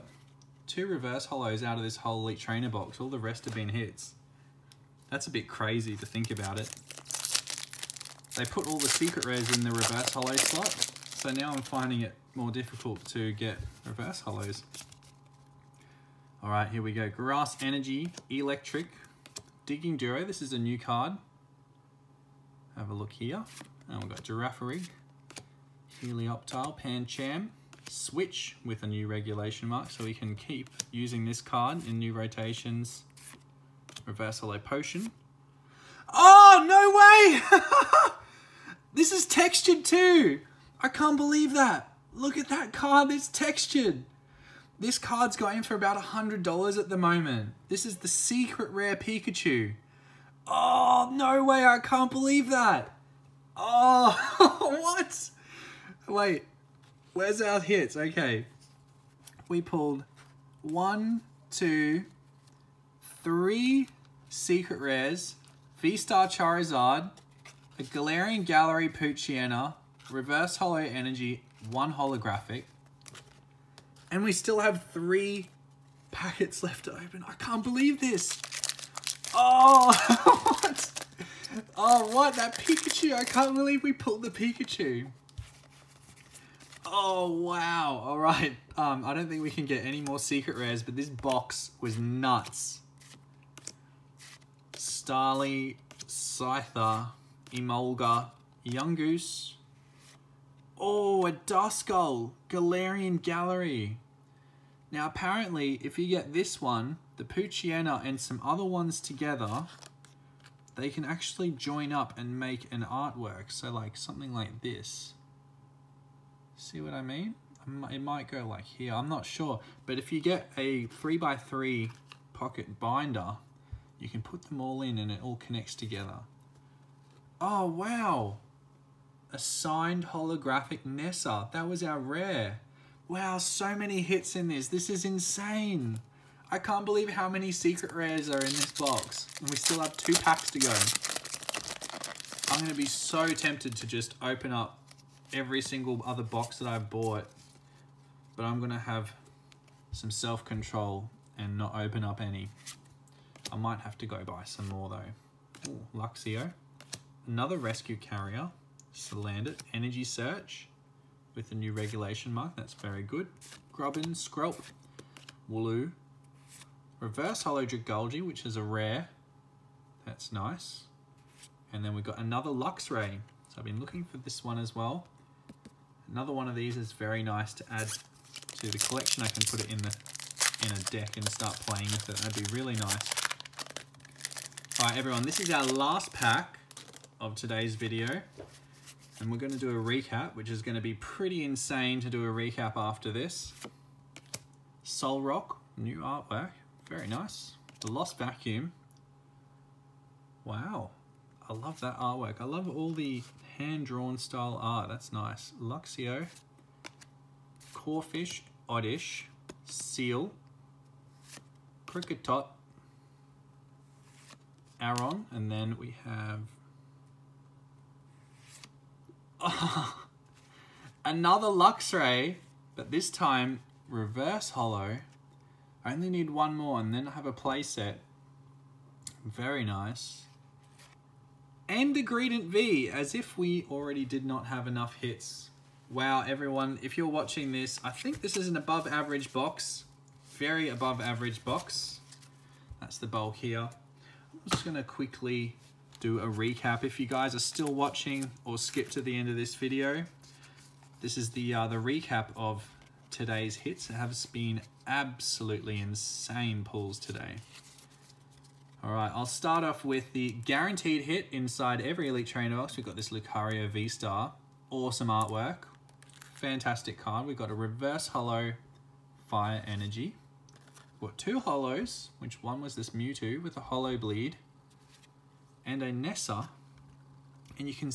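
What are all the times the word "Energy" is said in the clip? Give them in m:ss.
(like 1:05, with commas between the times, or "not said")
0:17, 1:10, 2:39, 4:29.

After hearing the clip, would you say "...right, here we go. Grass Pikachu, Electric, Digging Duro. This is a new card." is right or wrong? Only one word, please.
wrong.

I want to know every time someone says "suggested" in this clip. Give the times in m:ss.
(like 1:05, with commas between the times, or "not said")
not said.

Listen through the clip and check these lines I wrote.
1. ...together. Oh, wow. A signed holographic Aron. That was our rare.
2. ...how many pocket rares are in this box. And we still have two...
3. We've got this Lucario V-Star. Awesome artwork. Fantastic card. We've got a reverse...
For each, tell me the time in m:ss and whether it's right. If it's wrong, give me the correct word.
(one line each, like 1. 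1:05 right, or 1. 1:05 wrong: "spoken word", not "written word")
1. 2:05 wrong: "Nessa", not "Aron"
2. 2:17 wrong: "secret", not "pocket"
3. 4:22 right.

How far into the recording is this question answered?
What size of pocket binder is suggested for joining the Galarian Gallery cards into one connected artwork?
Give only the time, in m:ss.
2:00.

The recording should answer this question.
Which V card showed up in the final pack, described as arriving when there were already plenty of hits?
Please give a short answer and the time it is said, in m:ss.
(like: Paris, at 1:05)
Greedent V, at 3:52.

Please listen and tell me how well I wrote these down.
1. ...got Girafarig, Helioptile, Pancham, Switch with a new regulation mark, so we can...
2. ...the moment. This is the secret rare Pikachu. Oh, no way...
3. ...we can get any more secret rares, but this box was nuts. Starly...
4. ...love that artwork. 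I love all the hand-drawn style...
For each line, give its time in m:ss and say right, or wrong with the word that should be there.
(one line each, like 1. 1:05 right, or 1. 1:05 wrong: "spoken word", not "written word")
1. 0:24 right
2. 0:46 right
3. 1:29 right
4. 3:21 right.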